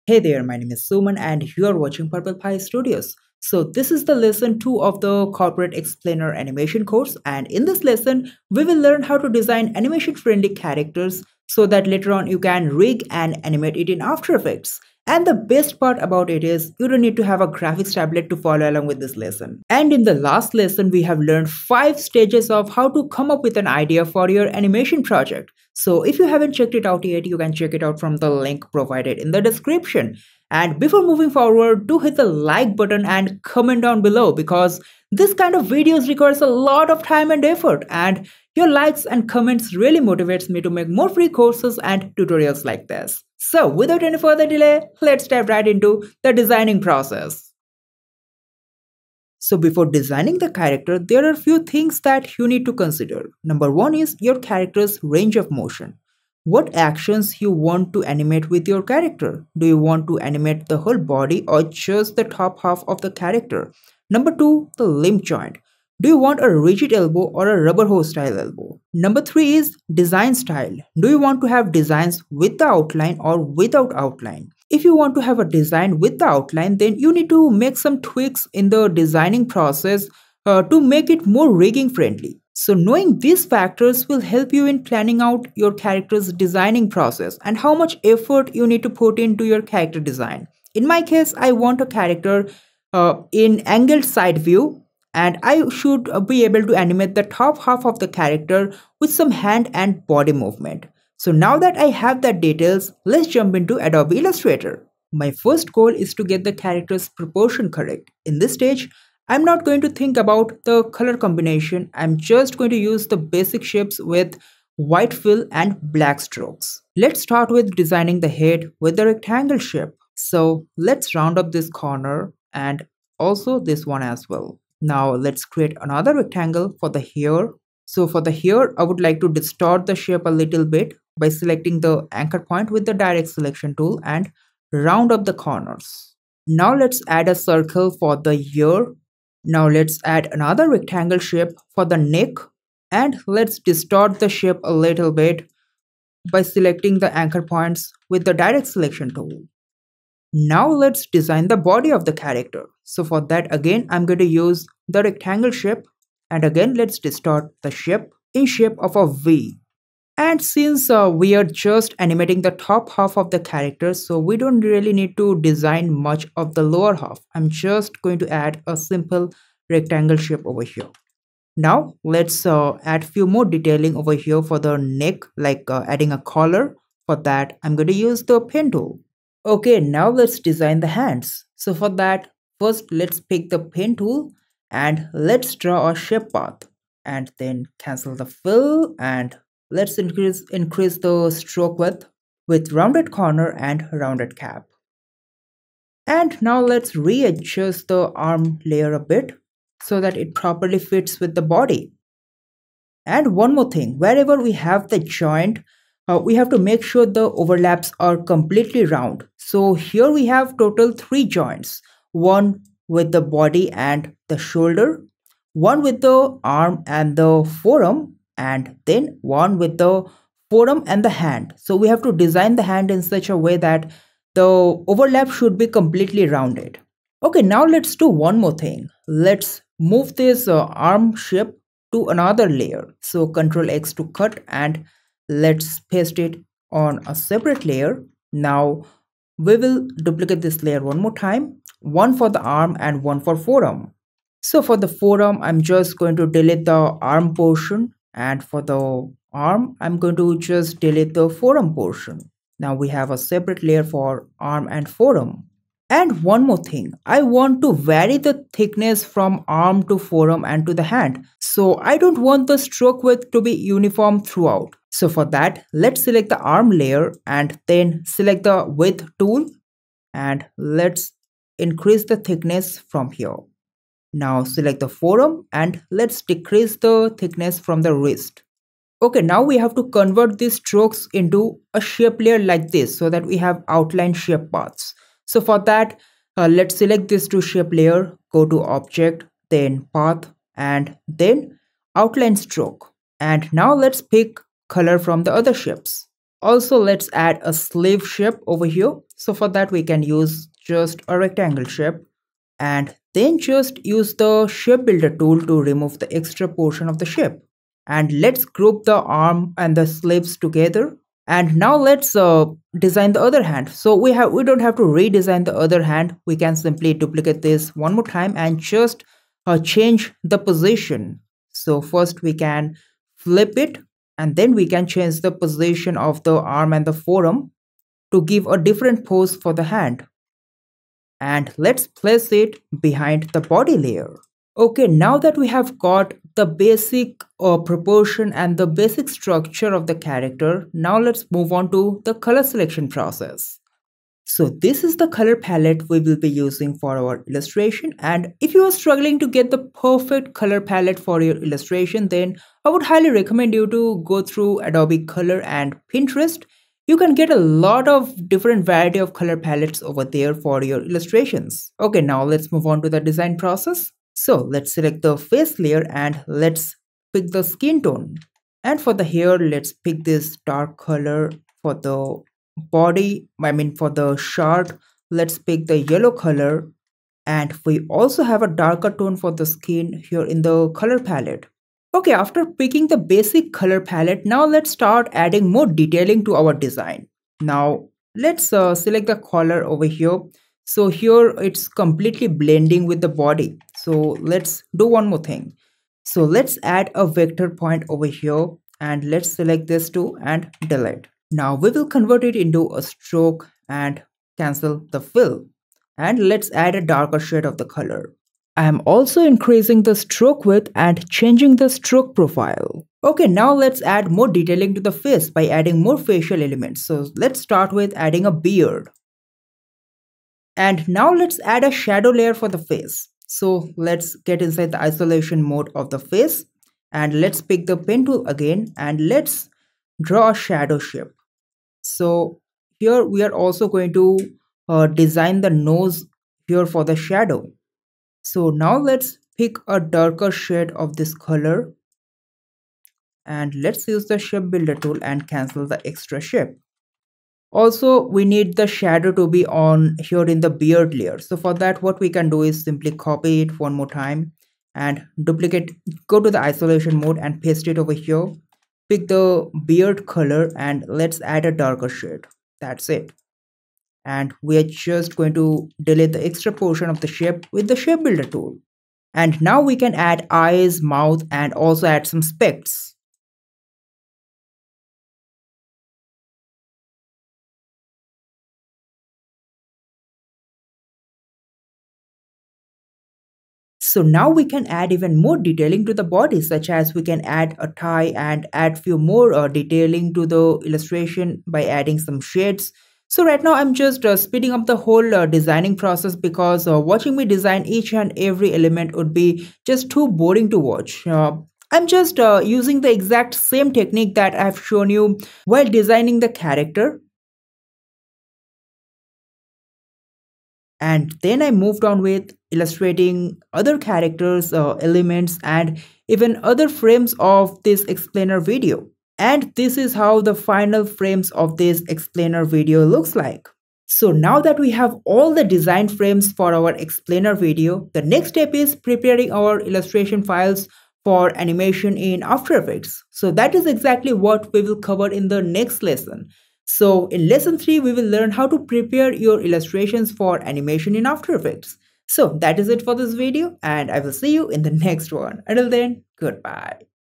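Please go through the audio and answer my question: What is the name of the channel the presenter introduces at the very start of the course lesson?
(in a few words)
Purple Pie Studios.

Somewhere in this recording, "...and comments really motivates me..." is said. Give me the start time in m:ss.
0:39.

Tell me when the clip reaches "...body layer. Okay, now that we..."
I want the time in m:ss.
5:33.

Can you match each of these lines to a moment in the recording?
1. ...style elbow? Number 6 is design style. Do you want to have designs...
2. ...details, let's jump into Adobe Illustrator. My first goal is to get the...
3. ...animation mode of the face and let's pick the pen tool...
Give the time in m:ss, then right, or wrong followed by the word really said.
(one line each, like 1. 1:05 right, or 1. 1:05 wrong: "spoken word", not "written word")
1. 1:08 wrong: "3", not "6"
2. 1:42 right
3. 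7:04 wrong: "isolation", not "animation".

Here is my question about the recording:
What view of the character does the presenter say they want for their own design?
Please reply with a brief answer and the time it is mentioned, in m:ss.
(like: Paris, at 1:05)
angled side view, at 1:33.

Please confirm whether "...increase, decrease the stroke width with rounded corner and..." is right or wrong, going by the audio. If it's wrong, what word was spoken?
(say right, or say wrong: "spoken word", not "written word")
wrong: "increase", not "decrease".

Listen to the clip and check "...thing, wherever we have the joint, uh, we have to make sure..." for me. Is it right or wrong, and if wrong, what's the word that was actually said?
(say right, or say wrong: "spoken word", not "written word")
right.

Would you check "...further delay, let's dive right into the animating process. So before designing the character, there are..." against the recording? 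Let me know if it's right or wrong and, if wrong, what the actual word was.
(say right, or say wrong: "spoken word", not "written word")
wrong: "designing", not "animating".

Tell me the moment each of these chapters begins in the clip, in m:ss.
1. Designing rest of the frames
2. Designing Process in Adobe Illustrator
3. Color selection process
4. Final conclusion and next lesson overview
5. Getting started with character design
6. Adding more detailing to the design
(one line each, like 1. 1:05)
1. 8:13
2. 0:46
3. 5:42
4. 8:43
5. 1:44
6. 6:25.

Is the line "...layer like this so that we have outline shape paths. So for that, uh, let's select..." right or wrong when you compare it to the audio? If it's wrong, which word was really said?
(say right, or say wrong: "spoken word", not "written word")
right.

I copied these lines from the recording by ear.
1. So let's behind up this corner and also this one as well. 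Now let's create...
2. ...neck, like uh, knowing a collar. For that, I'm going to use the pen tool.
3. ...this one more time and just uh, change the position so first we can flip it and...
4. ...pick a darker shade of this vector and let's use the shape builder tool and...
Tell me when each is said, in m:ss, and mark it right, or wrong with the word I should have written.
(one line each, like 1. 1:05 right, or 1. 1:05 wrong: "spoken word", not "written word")
1. 2:00 wrong: "round", not "behind"
2. 2:54 wrong: "adding", not "knowing"
3. 5:17 right
4. 7:19 wrong: "color", not "vector".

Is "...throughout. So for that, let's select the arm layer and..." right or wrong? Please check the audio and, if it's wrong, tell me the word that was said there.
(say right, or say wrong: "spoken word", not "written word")
right.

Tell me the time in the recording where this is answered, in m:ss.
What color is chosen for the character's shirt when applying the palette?
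6:15.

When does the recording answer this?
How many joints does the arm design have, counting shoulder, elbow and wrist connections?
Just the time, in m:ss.
3:30.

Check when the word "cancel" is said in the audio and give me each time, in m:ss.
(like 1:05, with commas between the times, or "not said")
3:07, 6:44, 7:25.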